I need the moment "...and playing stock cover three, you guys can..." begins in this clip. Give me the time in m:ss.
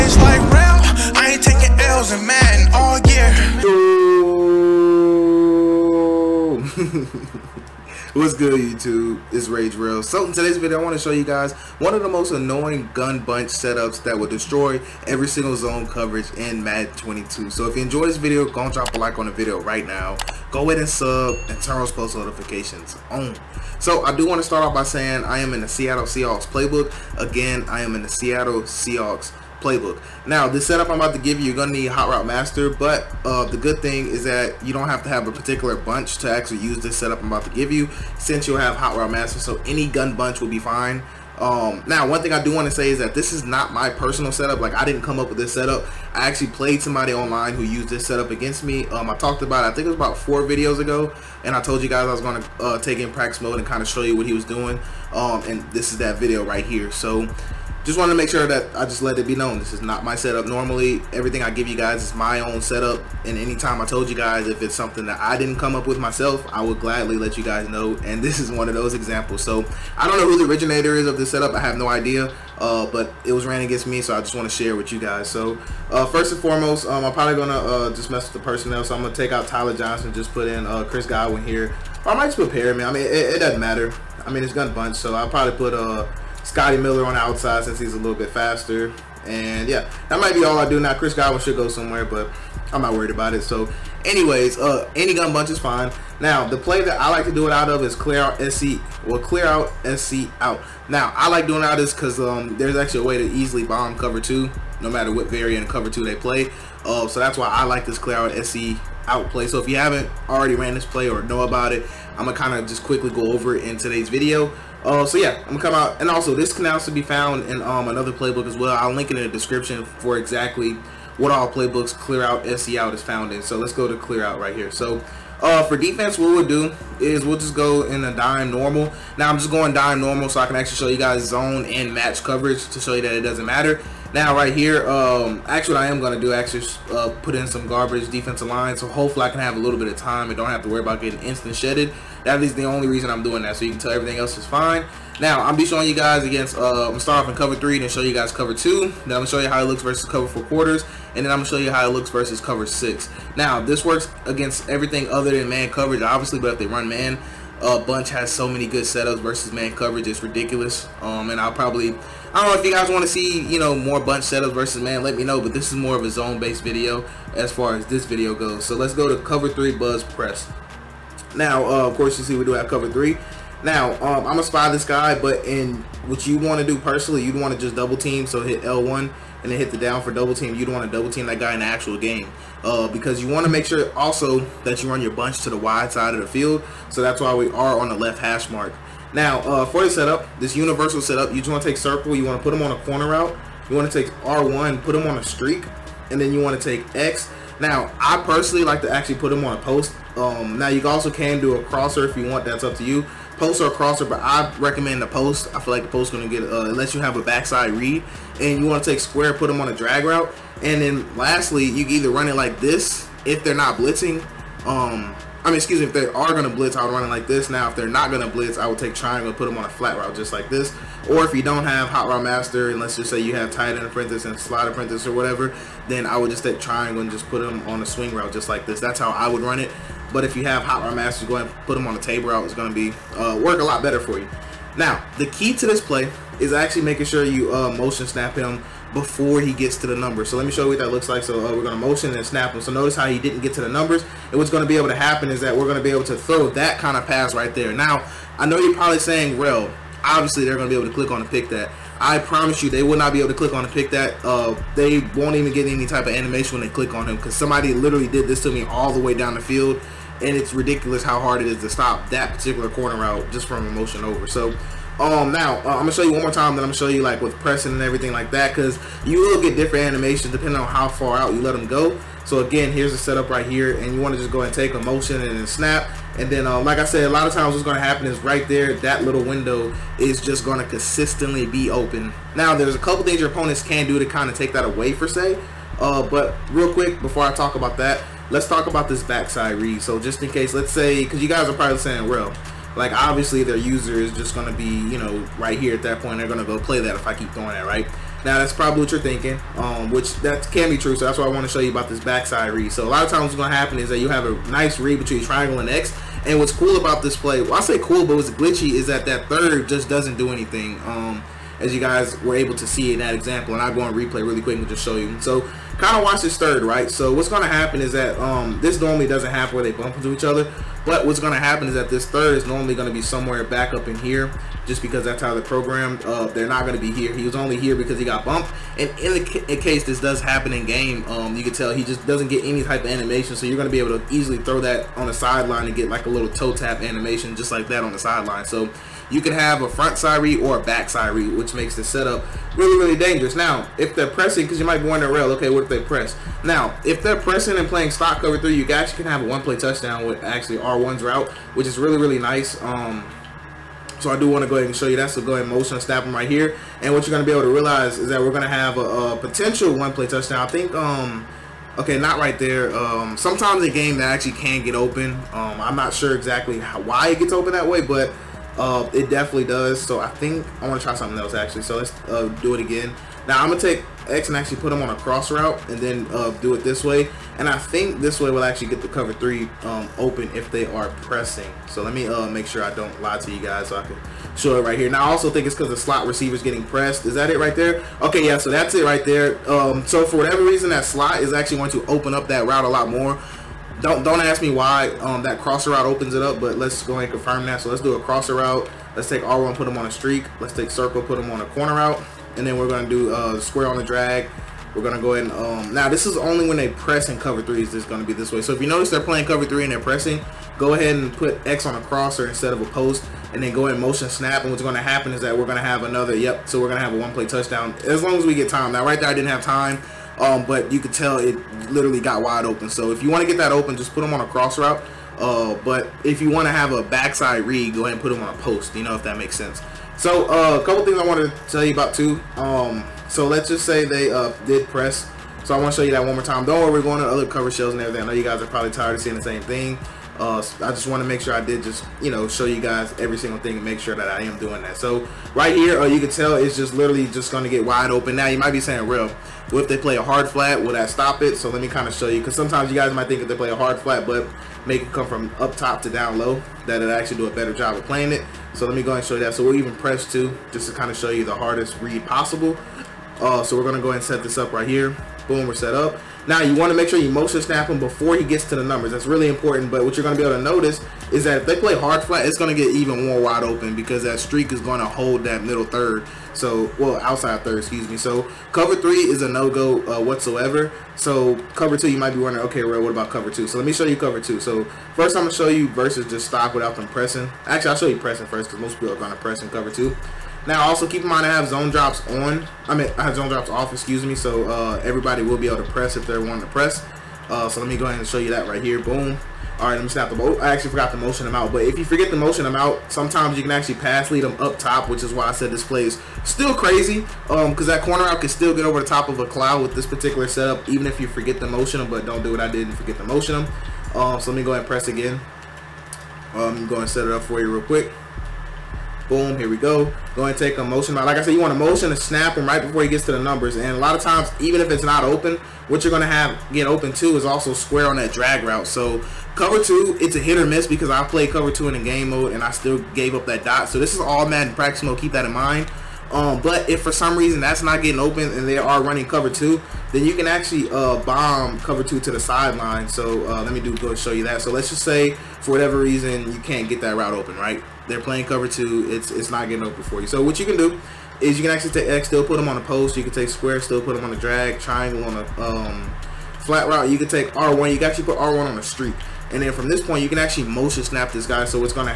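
5:47.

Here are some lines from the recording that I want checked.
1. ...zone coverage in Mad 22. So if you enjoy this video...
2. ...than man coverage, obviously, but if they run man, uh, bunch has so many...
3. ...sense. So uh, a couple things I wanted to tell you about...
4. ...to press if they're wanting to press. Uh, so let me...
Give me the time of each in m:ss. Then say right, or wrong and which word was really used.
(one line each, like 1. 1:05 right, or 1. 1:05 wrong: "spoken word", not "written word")
1. 0:15 right
2. 2:35 right
3. 7:09 right
4. 8:15 right.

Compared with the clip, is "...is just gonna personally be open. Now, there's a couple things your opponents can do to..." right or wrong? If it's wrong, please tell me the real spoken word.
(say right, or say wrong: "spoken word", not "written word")
wrong: "consistently", not "personally".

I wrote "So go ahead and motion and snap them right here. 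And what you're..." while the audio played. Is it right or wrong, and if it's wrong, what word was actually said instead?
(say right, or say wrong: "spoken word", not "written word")
right.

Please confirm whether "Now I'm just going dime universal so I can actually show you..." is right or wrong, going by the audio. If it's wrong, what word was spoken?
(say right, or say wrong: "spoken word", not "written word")
wrong: "normal", not "universal".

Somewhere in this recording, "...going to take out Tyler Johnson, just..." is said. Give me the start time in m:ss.
1:18.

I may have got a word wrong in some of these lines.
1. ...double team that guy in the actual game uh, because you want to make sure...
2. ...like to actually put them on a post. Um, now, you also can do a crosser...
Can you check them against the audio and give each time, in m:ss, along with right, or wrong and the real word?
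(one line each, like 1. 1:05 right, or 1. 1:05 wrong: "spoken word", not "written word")
1. 3:00 right
2. 3:18 right.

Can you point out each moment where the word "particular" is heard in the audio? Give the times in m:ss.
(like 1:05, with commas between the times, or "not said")
0:35, 4:22, 8:29.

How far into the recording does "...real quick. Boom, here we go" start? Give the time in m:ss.
8:37.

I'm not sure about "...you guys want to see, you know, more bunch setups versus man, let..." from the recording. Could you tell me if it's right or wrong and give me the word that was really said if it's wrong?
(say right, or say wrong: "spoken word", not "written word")
right.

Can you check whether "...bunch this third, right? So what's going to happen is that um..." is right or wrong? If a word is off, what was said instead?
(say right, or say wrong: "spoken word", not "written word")
wrong: "watch", not "bunch".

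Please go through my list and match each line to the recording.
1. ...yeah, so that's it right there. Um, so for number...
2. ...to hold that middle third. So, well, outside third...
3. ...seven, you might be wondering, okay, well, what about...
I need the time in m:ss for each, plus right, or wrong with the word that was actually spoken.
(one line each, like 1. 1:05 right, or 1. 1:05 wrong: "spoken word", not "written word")
1. 6:28 wrong: "whatever", not "number"
2. 7:54 right
3. 8:01 wrong: "two", not "seven".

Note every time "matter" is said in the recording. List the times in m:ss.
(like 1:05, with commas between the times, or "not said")
1:23, 1:44, 2:13.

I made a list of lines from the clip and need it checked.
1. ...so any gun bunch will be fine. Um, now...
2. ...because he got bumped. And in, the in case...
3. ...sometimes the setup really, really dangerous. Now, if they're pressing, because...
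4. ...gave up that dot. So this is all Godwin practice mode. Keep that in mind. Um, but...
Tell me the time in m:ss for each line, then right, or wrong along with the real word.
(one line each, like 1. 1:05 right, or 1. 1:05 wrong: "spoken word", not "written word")
1. 0:39 right
2. 5:27 right
3. 5:41 wrong: "makes", not "sometimes"
4. 8:52 wrong: "Madden", not "Godwin".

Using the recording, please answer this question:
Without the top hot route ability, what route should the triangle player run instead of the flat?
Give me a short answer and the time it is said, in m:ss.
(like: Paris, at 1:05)
Swing route, at 3:47.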